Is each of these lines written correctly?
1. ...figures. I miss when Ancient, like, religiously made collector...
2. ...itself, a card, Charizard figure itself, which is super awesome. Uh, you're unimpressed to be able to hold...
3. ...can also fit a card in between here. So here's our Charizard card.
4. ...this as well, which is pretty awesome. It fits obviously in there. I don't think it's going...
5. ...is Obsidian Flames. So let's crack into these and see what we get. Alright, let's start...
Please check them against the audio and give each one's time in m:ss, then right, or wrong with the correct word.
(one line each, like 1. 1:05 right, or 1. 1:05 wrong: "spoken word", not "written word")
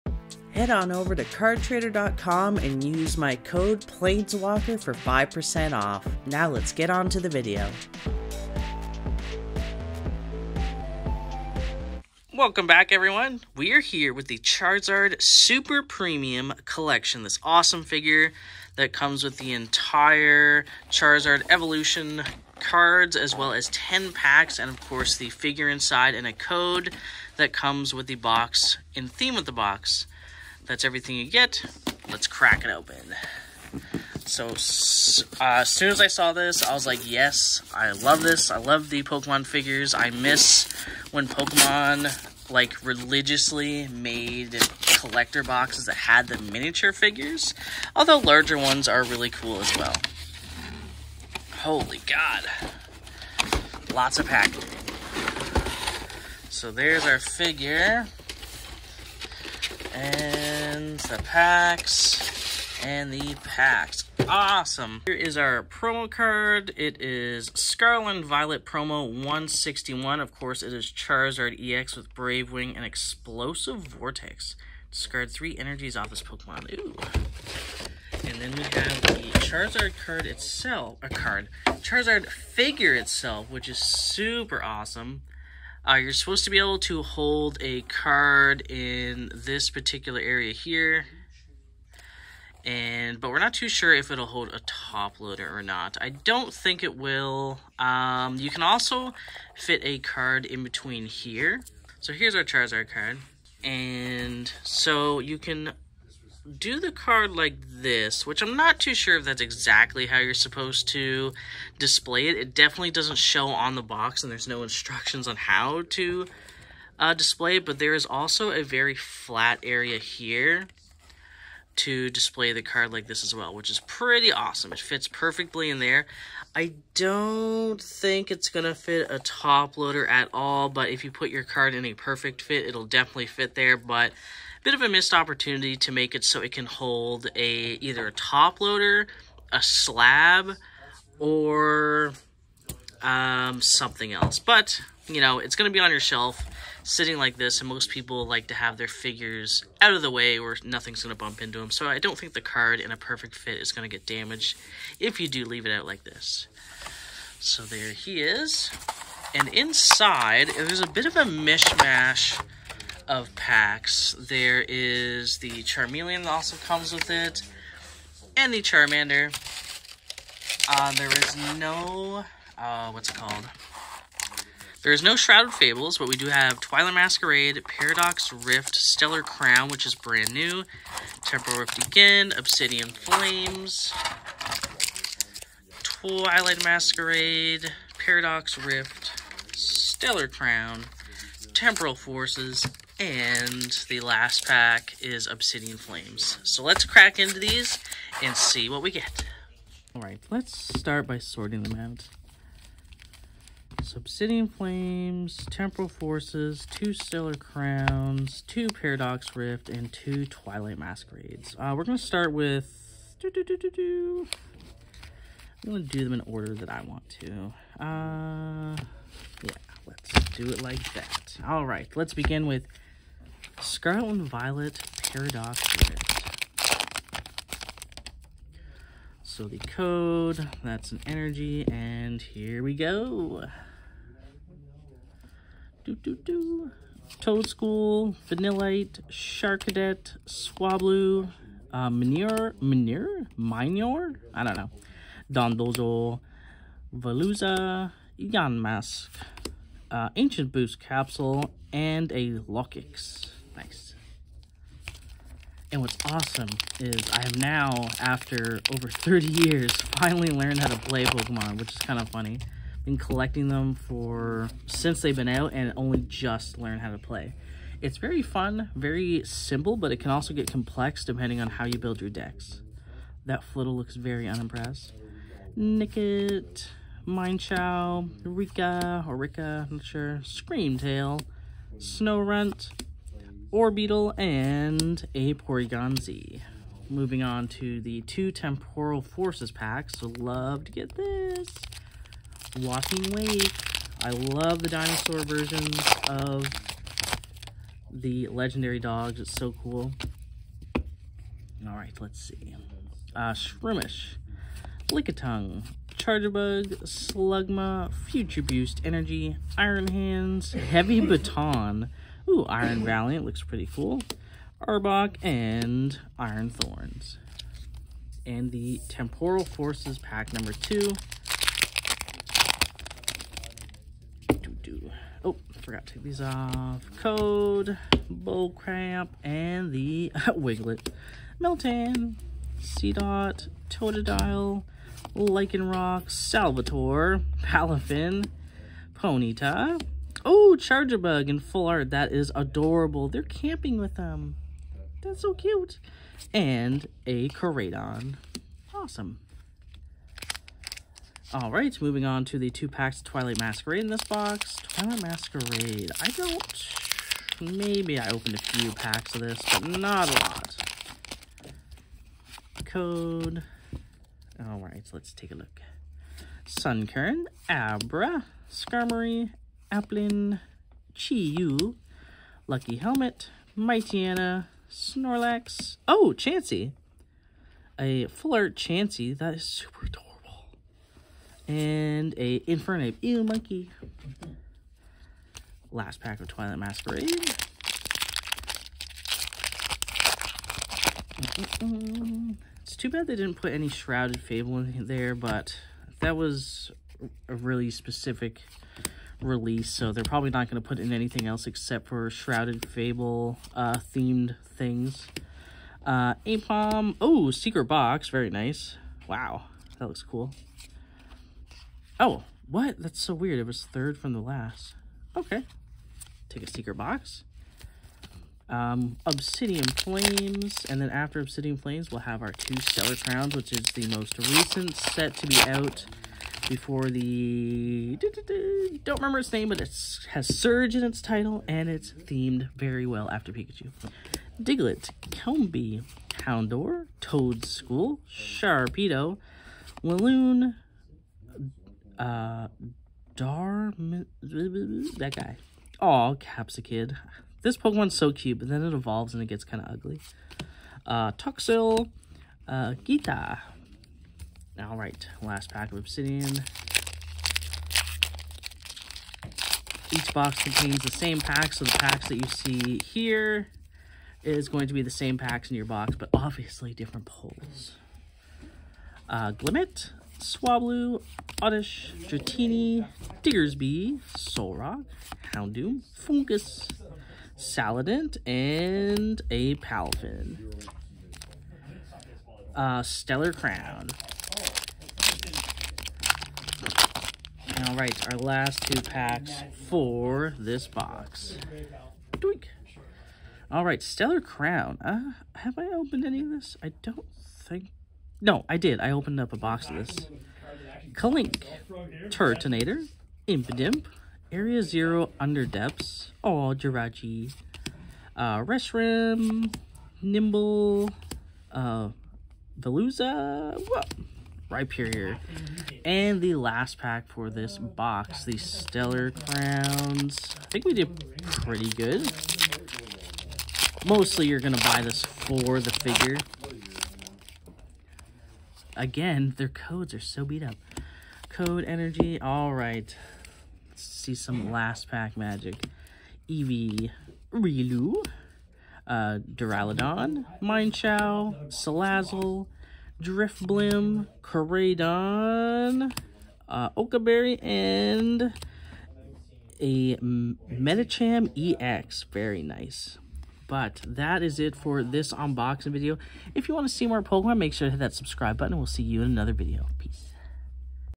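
1. 0:39 wrong: "Pokemon", not "Ancient"
2. 1:20 wrong: "supposed", not "unimpressed"
3. 1:38 right
4. 2:03 wrong: "perfectly", not "obviously"
5. 3:14 right.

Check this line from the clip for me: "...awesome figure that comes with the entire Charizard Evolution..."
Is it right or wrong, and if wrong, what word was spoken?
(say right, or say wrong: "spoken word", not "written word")
right.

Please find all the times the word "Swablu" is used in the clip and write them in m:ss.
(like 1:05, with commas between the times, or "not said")
4:00, 7:50.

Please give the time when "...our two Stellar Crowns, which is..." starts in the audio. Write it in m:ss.
7:02.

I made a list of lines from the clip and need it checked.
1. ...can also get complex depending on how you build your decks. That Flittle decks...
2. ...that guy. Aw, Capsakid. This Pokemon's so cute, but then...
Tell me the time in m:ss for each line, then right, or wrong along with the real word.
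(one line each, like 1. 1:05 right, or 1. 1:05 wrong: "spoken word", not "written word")
1. 4:30 wrong: "looks", not "decks"
2. 7:24 right.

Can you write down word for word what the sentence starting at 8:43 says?
Mostly you're going to buy this for the figure.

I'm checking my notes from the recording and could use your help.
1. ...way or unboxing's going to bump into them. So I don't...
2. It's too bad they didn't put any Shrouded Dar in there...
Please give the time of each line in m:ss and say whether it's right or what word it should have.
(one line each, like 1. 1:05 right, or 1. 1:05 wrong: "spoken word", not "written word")
1. 2:30 wrong: "nothing", not "unboxing"
2. 6:32 wrong: "Fable", not "Dar".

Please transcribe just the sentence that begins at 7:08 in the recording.
Don't remember its name, but it has Surge in its title, and it's themed very well after Pikachu.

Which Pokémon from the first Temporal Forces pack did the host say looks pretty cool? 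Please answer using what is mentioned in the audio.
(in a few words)
Iron Valiant.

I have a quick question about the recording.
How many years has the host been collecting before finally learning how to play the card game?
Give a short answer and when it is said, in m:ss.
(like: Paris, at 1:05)
over 30, at 4:18.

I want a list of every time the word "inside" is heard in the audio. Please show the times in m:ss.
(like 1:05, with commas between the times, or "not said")
0:25, 2:39.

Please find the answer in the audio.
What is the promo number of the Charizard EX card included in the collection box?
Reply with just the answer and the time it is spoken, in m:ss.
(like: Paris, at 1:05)
161, at 1:08.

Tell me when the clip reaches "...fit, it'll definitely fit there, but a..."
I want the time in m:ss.
2:12.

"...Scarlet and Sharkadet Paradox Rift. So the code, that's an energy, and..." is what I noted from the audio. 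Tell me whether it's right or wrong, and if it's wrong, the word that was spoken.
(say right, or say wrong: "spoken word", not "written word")
wrong: "Violet", not "Sharkadet".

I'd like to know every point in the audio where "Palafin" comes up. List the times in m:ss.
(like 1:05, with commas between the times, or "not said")
5:37, 7:59.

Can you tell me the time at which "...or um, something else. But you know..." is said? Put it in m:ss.
2:21.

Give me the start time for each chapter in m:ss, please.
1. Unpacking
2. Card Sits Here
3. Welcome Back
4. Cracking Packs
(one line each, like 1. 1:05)
1. 0:53
2. 1:56
3. 0:12
4. 3:39.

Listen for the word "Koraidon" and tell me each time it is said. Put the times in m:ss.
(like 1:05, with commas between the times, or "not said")
5:47, 9:04.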